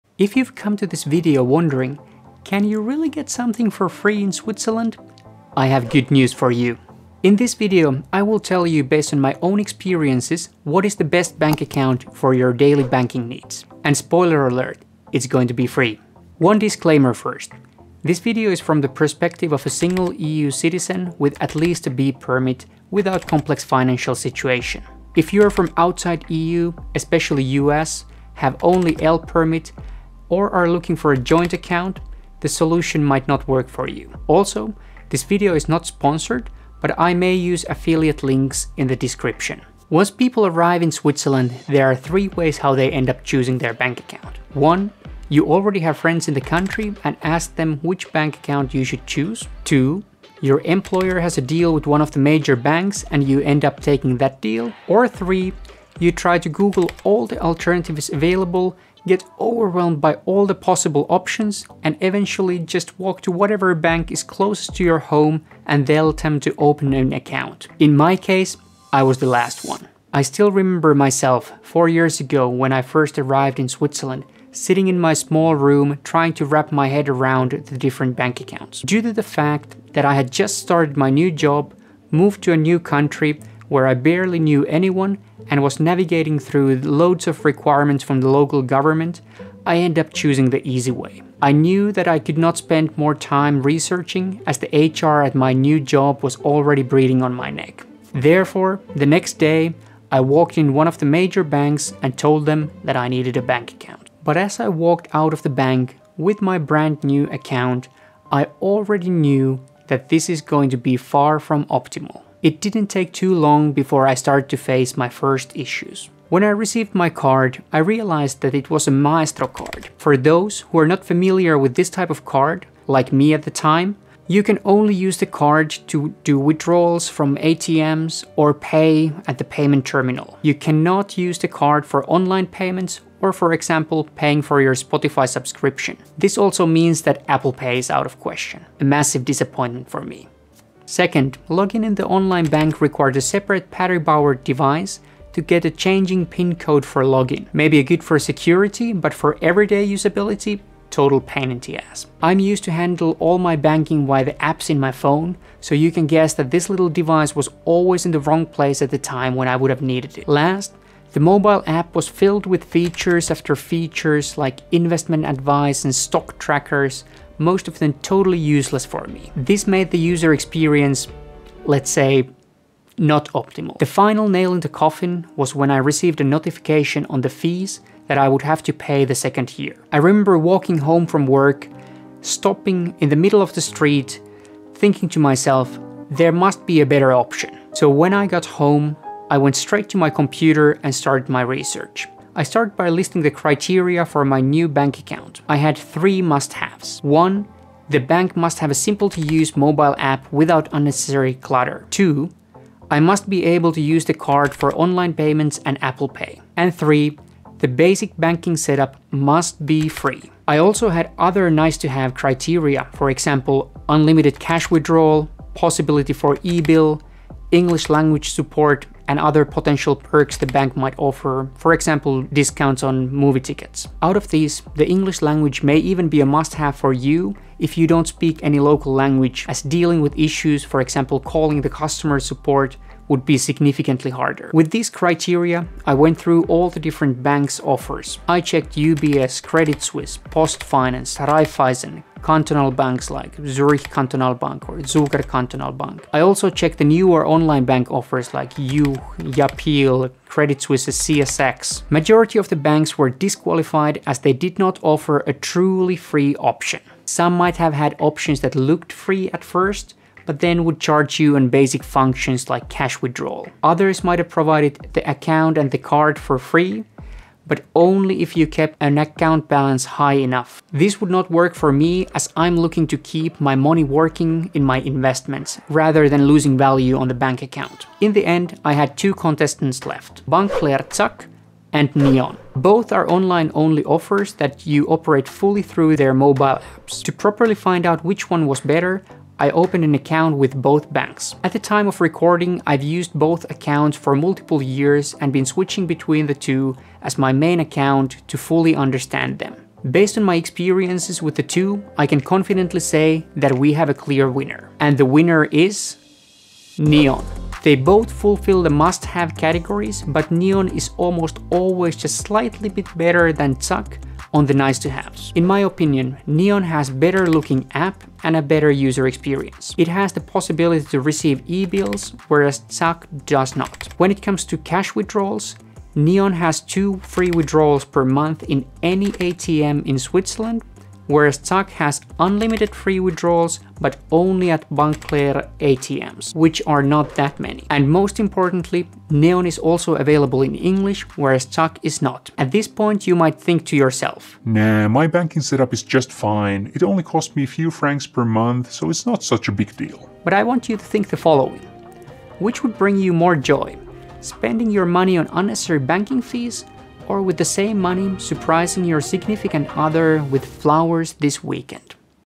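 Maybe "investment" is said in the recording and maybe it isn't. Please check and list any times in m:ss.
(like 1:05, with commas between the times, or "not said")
2:44, 4:34.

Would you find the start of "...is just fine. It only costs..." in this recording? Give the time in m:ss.
5:45.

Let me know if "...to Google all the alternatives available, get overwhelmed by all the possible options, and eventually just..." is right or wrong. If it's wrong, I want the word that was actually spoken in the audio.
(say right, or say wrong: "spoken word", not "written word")
right.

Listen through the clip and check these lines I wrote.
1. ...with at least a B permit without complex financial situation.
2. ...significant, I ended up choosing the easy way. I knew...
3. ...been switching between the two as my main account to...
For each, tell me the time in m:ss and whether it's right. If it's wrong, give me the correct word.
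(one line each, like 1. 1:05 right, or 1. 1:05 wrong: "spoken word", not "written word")
1. 0:21 right
2. 1:28 wrong: "government", not "significant"
3. 4:55 right.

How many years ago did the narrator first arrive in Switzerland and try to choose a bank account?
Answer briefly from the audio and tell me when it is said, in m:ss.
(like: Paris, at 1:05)
4 years, at 1:11.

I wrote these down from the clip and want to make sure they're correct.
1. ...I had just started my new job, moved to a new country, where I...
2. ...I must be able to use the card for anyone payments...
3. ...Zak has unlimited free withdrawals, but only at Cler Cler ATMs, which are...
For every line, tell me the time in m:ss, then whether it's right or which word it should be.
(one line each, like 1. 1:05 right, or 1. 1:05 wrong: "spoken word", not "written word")
1. 1:20 right
2. 3:22 wrong: "online", not "anyone"
3. 5:31 wrong: "Bank", not "Cler".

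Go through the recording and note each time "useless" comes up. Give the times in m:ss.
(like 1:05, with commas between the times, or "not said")
2:48.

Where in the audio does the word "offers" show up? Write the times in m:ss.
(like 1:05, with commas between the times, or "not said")
3:40, 3:57, 4:07, 4:14, 4:43.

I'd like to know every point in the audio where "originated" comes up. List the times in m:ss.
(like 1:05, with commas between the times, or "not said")
not said.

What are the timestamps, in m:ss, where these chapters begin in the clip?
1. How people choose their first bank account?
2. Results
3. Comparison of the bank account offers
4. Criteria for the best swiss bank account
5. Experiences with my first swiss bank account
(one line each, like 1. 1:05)
1. 0:40
2. 5:00
3. 3:54
4. 3:12
5. 1:52.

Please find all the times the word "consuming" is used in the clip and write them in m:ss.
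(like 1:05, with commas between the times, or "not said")
not said.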